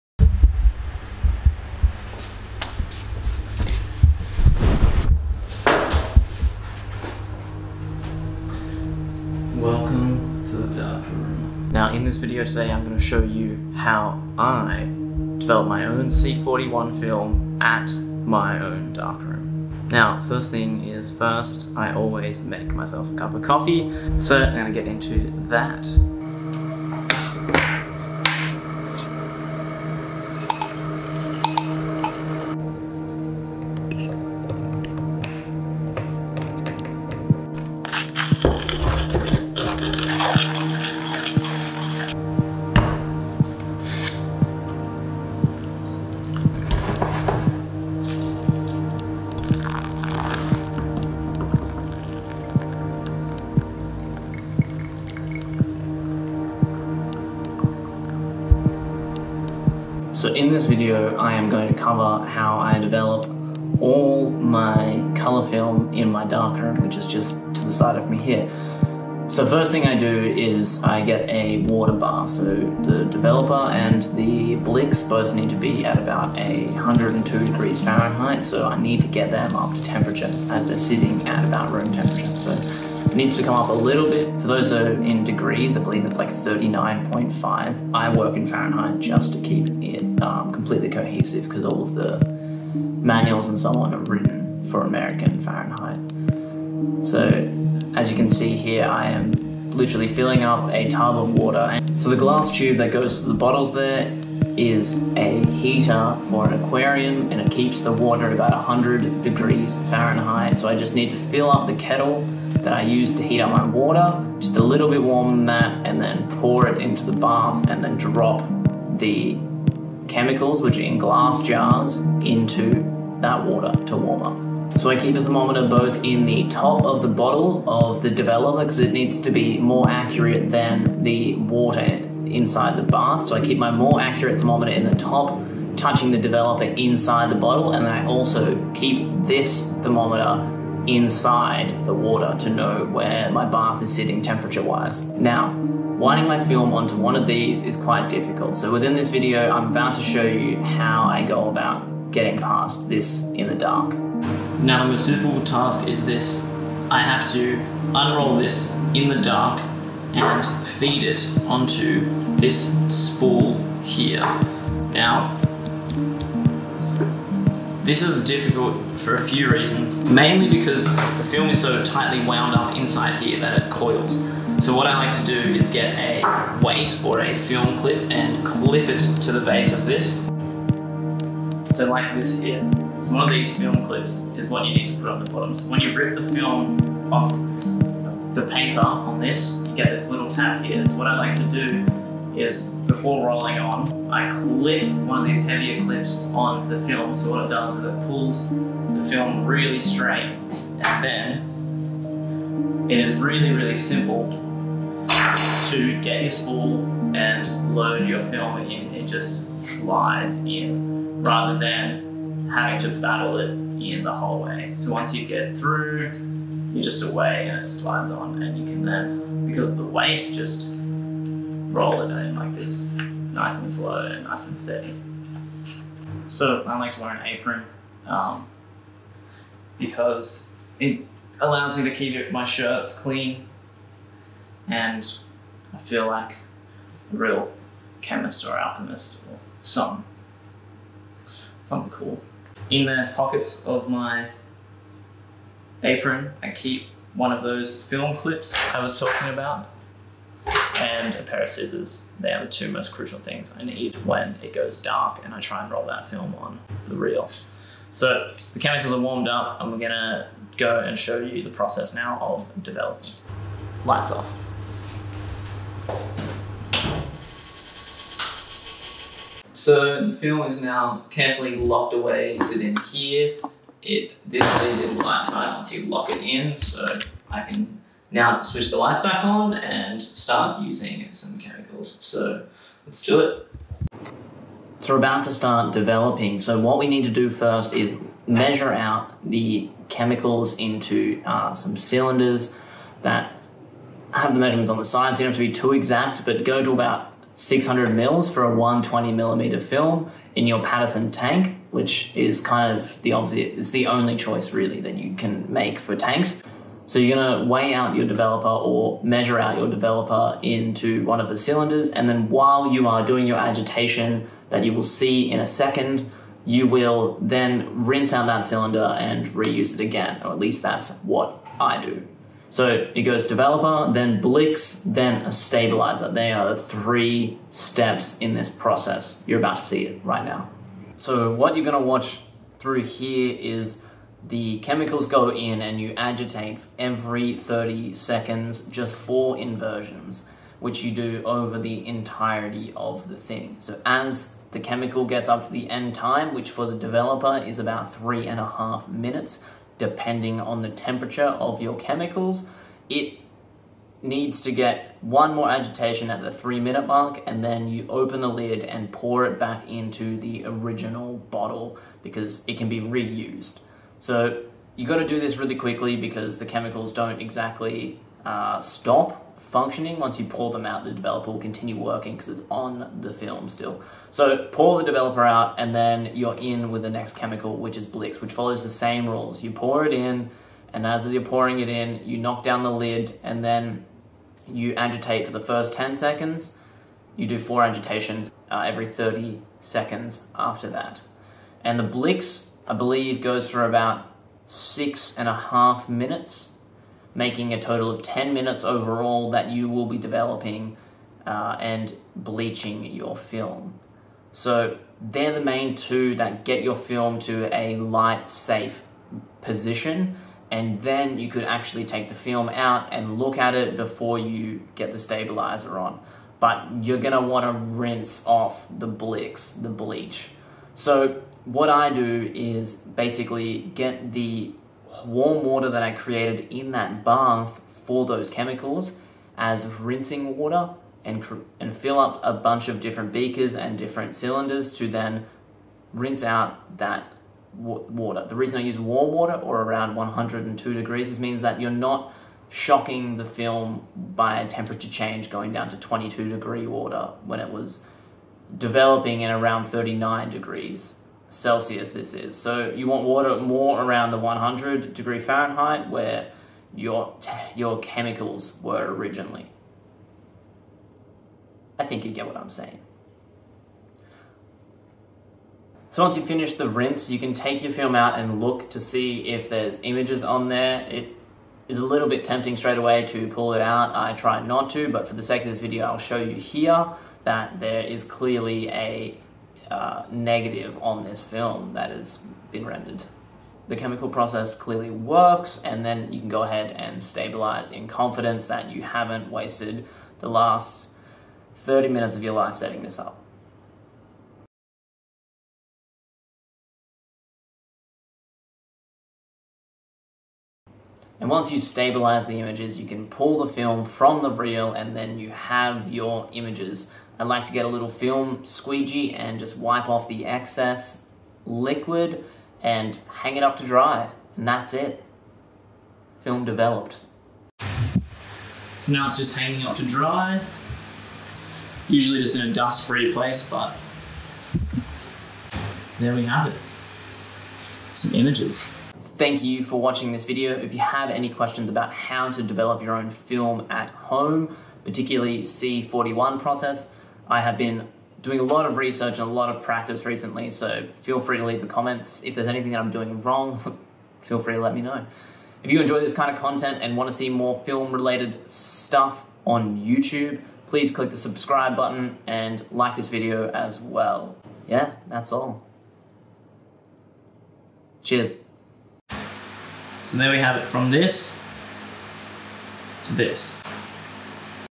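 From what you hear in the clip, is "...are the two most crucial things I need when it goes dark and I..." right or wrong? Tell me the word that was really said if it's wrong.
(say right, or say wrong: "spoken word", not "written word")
right.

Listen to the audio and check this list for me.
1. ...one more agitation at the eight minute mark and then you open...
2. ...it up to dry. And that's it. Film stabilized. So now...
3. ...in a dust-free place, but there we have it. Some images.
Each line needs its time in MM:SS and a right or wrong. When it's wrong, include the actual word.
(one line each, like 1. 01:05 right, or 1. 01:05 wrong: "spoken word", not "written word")
1. 05:55 wrong: "three", not "eight"
2. 08:33 wrong: "developed", not "stabilized"
3. 08:42 right.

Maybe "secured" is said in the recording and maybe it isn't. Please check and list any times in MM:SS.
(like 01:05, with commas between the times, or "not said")
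not said.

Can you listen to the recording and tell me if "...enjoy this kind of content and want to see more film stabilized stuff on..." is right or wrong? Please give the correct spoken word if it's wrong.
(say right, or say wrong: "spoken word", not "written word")
wrong: "related", not "stabilized".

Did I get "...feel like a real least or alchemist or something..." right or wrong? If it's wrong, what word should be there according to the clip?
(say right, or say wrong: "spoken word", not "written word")
wrong: "chemist", not "least".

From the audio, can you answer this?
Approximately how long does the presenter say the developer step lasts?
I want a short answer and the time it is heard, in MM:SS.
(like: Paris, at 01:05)
3.5 minutes, at 05:47.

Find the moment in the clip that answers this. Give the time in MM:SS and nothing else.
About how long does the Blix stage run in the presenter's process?
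06:34.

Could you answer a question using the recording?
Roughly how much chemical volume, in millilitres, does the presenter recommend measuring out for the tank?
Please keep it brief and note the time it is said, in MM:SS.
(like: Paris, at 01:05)
600 ml, at 04:57.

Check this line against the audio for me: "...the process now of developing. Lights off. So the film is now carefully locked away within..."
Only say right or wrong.
right.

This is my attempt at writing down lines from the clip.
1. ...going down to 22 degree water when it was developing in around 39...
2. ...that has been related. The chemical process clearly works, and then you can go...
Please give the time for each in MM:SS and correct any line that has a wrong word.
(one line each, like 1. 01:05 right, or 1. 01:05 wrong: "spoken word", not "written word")
1. 07:25 right
2. 08:01 wrong: "rendered", not "related".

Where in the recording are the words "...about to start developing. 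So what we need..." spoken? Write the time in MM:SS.
04:44.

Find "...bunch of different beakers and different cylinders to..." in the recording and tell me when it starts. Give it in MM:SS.
07:12.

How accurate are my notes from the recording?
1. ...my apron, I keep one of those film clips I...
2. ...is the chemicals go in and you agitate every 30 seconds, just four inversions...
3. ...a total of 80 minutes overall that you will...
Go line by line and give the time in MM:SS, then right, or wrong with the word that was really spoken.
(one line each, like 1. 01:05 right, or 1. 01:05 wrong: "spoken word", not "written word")
1. 04:03 right
2. 05:33 right
3. 06:37 wrong: "10", not "80".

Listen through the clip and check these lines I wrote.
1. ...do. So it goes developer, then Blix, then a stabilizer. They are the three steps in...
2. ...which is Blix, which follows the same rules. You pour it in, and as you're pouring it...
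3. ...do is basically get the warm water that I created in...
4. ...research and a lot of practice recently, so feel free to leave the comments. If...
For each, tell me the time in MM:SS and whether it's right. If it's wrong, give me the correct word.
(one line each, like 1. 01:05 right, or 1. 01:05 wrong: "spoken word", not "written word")
1. 05:21 right
2. 06:17 right
3. 07:01 right
4. 08:58 right.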